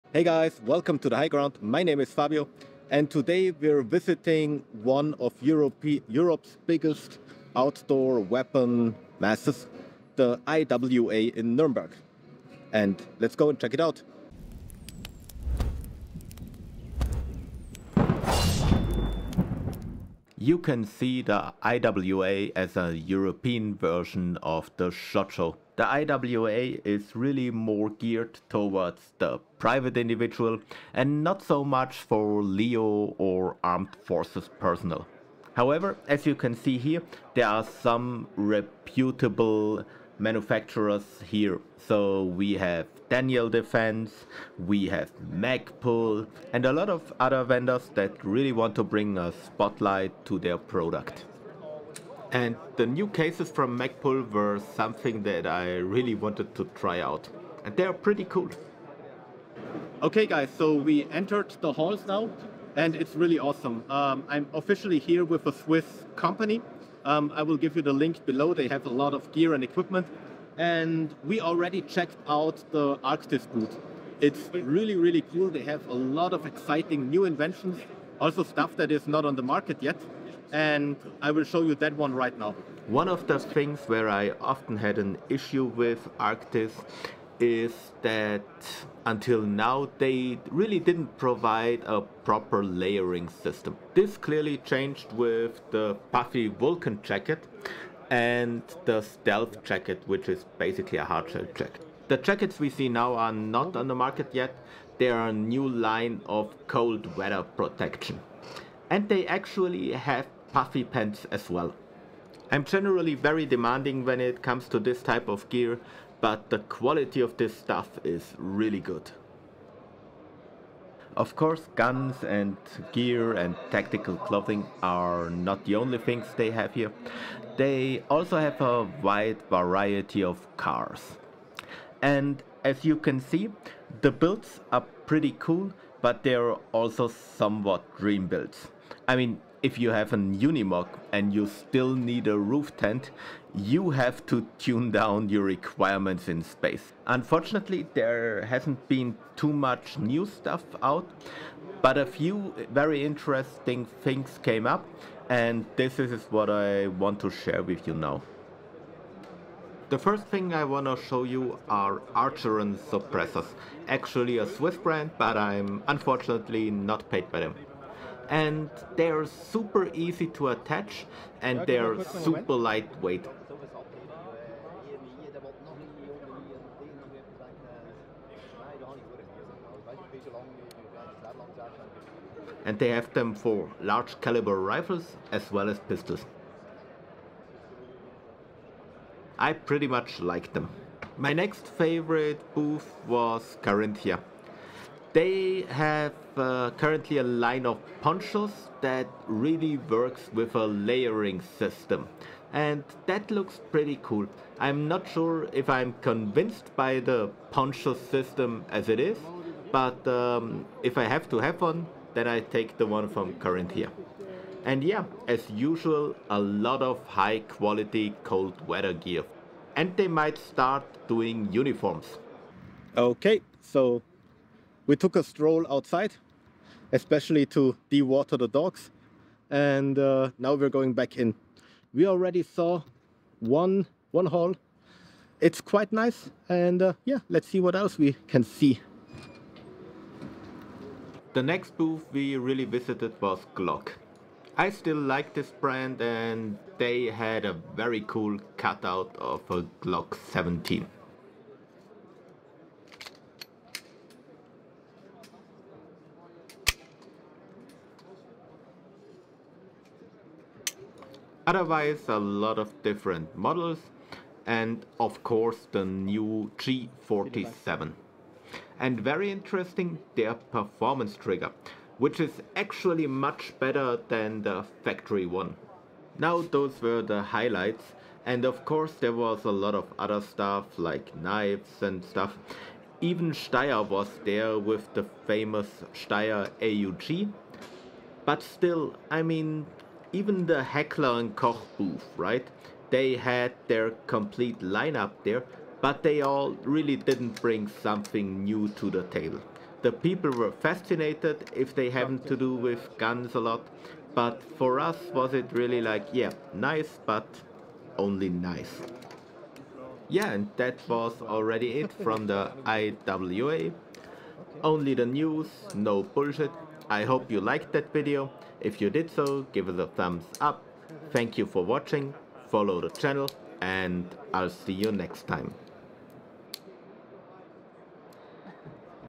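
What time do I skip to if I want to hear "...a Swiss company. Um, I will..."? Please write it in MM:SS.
01:05.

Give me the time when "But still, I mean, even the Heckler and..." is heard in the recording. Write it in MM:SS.
04:48.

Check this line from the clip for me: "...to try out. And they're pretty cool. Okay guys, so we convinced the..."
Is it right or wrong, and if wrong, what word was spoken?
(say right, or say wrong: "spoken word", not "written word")
wrong: "entered", not "convinced".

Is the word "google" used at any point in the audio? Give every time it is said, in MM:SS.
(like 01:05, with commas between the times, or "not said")
not said.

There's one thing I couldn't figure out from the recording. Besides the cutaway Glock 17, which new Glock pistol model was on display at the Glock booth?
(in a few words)
G47.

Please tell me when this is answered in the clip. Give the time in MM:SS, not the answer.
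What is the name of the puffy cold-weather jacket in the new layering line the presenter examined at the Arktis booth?
01:36.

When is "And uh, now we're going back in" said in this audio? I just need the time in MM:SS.
03:49.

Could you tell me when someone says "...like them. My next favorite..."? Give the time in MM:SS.
03:10.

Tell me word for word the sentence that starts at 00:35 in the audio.
However, as you can see here, there are some reputable manufacturers here.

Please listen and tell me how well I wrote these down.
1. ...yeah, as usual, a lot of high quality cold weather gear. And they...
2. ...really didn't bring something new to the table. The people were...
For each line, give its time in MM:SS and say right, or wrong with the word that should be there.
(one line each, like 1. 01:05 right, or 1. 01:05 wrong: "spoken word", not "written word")
1. 03:34 right
2. 04:56 right.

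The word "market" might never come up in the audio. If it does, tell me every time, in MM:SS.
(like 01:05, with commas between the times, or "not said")
01:19, 01:43.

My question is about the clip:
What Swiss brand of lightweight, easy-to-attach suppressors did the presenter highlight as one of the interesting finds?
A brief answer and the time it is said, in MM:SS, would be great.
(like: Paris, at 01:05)
Archeron, at 02:42.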